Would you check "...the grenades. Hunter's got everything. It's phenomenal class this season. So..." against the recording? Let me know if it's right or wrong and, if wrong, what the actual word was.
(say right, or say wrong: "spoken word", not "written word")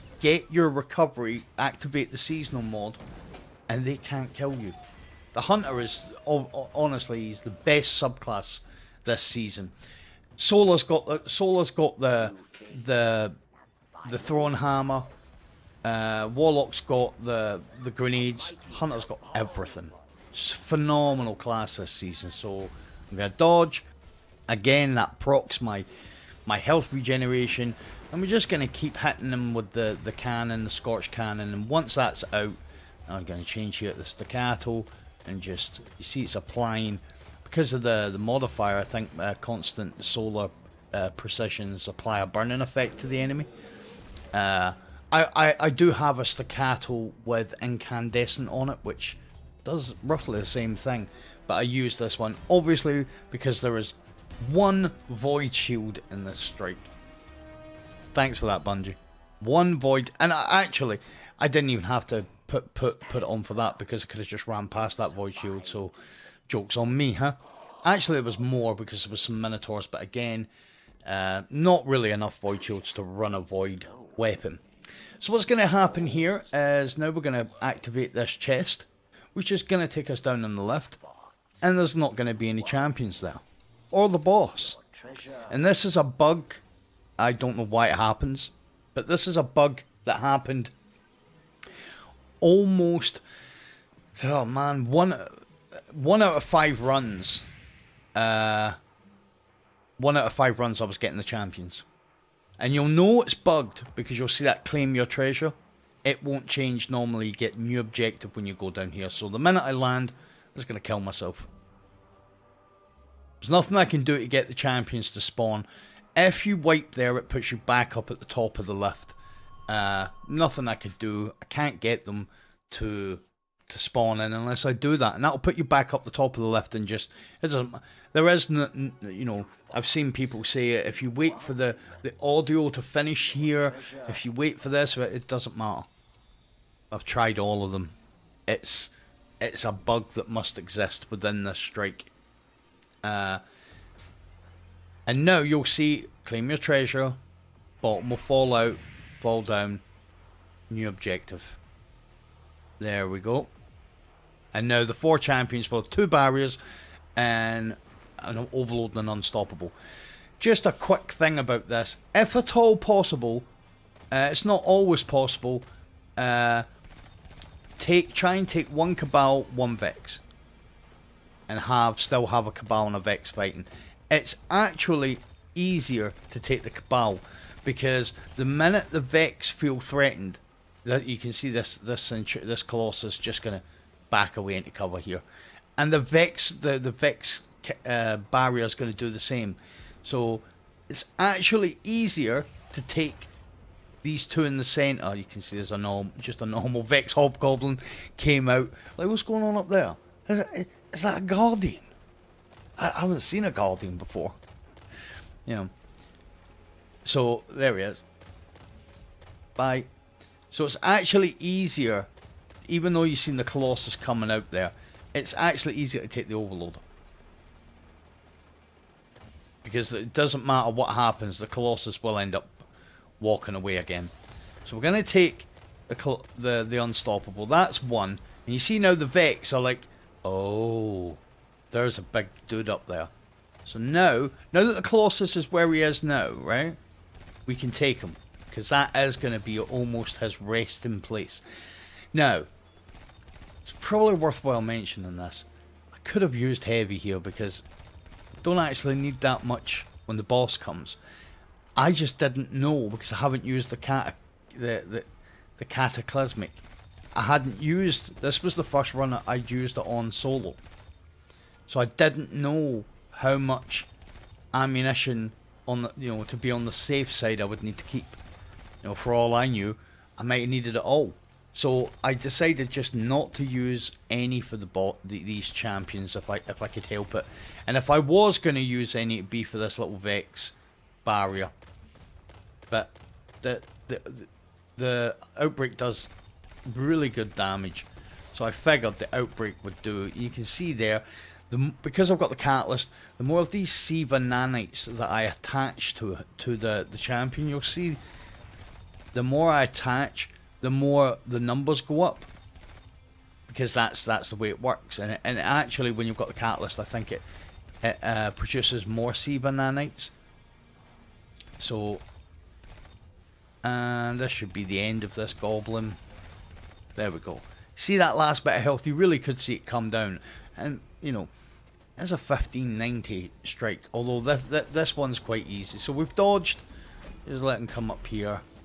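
right.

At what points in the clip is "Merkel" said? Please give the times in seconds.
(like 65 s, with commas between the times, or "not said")
not said.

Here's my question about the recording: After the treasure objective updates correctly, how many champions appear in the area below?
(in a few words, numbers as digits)
4.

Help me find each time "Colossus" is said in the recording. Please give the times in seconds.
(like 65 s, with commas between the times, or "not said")
182 s, 213 s, 221 s, 234 s.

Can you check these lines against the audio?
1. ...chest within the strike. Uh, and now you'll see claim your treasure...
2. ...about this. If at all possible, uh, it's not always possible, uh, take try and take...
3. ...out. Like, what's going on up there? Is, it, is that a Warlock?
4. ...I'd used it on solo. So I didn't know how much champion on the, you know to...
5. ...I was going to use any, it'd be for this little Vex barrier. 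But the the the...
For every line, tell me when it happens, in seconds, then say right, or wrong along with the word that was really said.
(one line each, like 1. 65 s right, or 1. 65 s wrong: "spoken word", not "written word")
1. 140 s wrong: "exist", not "chest"
2. 161 s right
3. 198 s wrong: "Guardian", not "Warlock"
4. 259 s wrong: "ammunition", not "champion"
5. 277 s right.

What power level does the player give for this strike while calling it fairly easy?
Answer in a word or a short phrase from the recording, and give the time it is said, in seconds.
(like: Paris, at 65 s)
1590, at 322 s.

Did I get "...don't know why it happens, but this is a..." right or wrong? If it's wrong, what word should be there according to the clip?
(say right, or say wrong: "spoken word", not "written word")
right.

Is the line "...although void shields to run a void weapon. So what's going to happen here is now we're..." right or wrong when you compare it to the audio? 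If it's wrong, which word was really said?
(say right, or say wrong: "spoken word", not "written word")
wrong: "enough", not "although".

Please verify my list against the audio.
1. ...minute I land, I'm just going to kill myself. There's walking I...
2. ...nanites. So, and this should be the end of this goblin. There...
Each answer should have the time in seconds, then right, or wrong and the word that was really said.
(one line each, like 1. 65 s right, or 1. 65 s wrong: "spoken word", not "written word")
1. 109 s wrong: "nothing", not "walking"
2. 309 s right.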